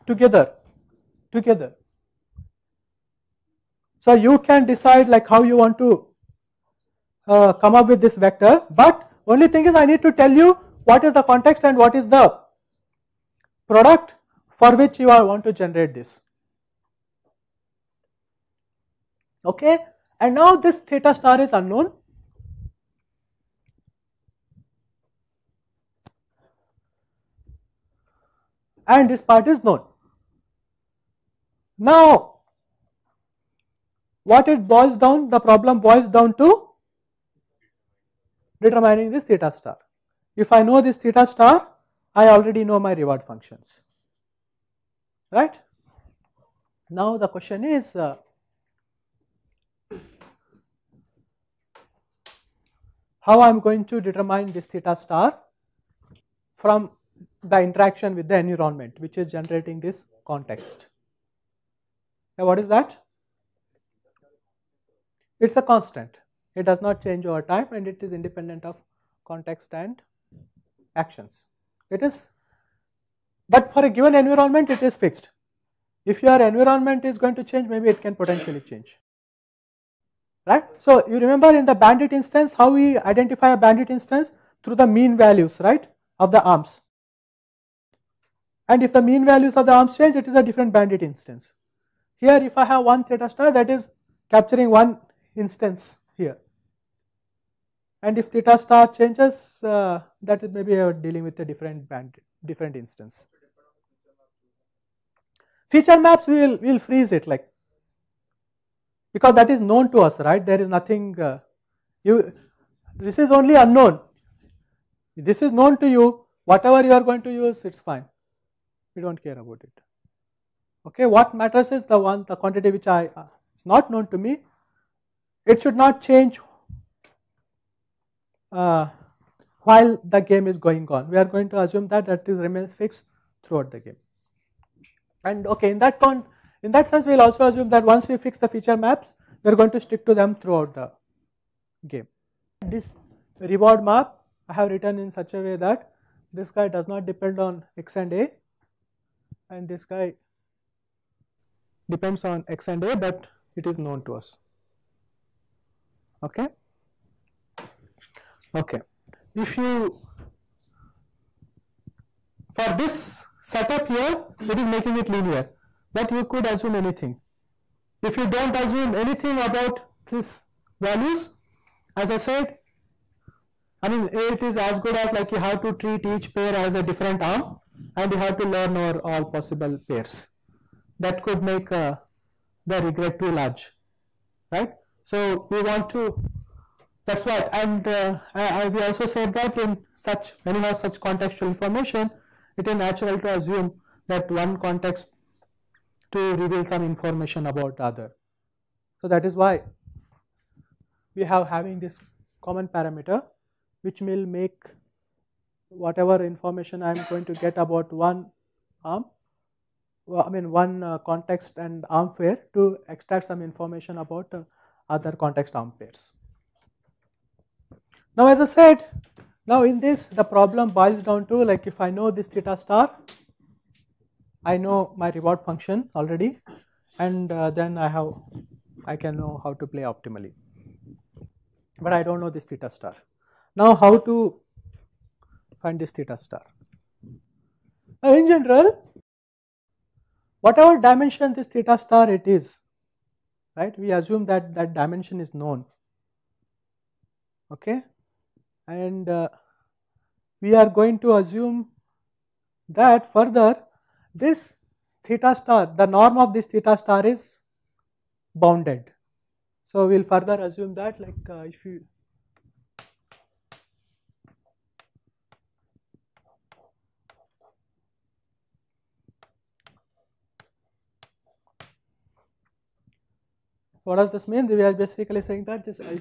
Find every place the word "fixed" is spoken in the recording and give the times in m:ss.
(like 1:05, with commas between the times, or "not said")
1:14, 2:12.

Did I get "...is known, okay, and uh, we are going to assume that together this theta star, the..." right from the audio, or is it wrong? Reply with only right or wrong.
wrong.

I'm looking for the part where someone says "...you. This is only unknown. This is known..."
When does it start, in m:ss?
1:52.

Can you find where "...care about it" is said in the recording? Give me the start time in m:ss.
1:59.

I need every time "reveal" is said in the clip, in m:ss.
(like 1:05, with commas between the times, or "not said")
3:16.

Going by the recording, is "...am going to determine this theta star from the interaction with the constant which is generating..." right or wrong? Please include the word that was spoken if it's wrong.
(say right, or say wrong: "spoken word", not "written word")
wrong: "environment", not "constant".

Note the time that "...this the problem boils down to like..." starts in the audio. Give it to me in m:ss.
3:39.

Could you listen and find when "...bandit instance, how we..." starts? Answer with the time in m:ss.
1:21.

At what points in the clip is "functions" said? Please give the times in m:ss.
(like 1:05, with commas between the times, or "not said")
0:43, 3:45.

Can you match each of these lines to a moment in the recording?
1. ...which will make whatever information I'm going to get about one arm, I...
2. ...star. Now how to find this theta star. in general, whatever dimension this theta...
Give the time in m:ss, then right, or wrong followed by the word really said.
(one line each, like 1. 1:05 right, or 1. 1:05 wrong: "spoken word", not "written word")
1. 3:23 right
2. 3:52 right.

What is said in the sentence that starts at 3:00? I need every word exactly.
That could make uh, the regret too large, right?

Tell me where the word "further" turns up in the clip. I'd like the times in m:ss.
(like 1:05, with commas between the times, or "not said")
4:13, 4:20.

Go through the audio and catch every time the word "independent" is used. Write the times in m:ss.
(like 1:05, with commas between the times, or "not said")
1:08.